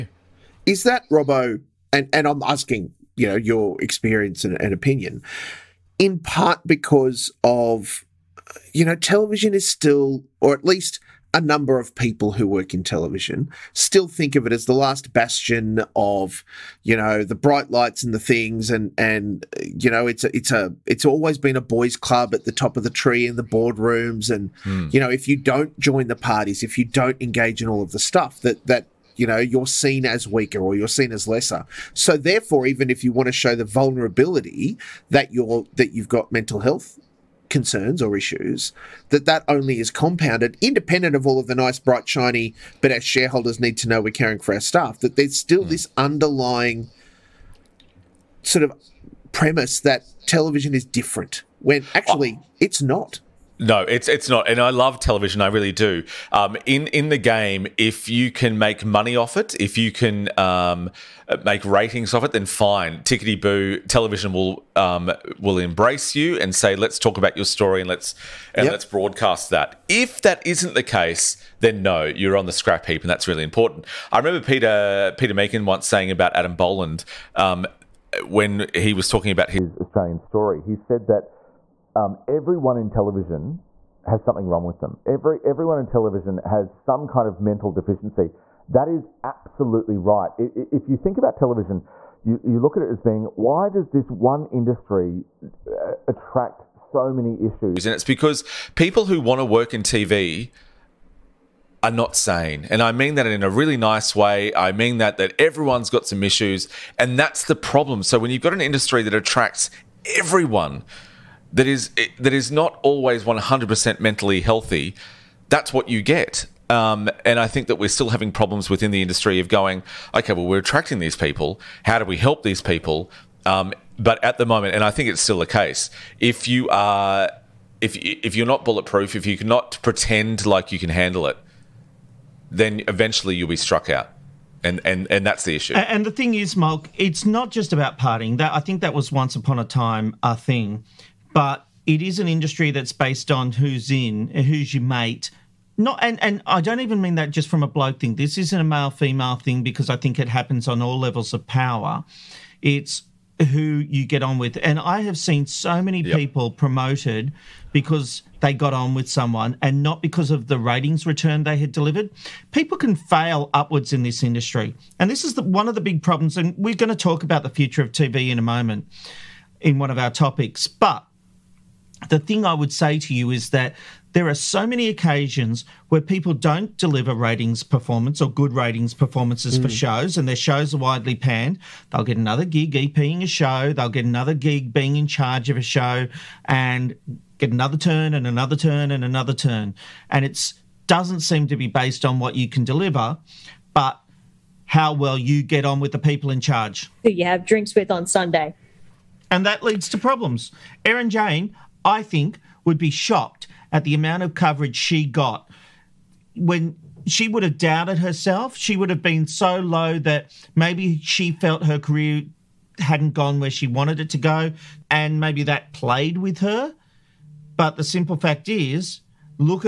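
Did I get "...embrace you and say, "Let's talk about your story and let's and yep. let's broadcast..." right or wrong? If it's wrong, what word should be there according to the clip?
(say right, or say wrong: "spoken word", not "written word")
right.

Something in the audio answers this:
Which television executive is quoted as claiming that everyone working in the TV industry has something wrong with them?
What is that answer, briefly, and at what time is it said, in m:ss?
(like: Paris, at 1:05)
Peter Meakin, at 1:15.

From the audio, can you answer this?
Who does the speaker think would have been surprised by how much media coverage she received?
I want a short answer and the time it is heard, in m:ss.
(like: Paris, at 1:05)
Erin Jayne, at 3:20.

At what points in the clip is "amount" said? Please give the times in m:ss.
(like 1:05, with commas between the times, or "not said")
3:23.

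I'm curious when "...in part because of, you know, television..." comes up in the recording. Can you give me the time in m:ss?
0:05.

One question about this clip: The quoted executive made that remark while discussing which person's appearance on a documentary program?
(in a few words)
Adam Boland.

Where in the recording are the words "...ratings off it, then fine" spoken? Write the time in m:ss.
1:01.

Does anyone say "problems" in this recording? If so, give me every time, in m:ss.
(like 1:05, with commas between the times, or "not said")
1:47, 1:58, 2:46, 3:19.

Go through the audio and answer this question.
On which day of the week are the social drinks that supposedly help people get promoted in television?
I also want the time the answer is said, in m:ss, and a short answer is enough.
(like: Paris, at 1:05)
Sunday, at 3:18.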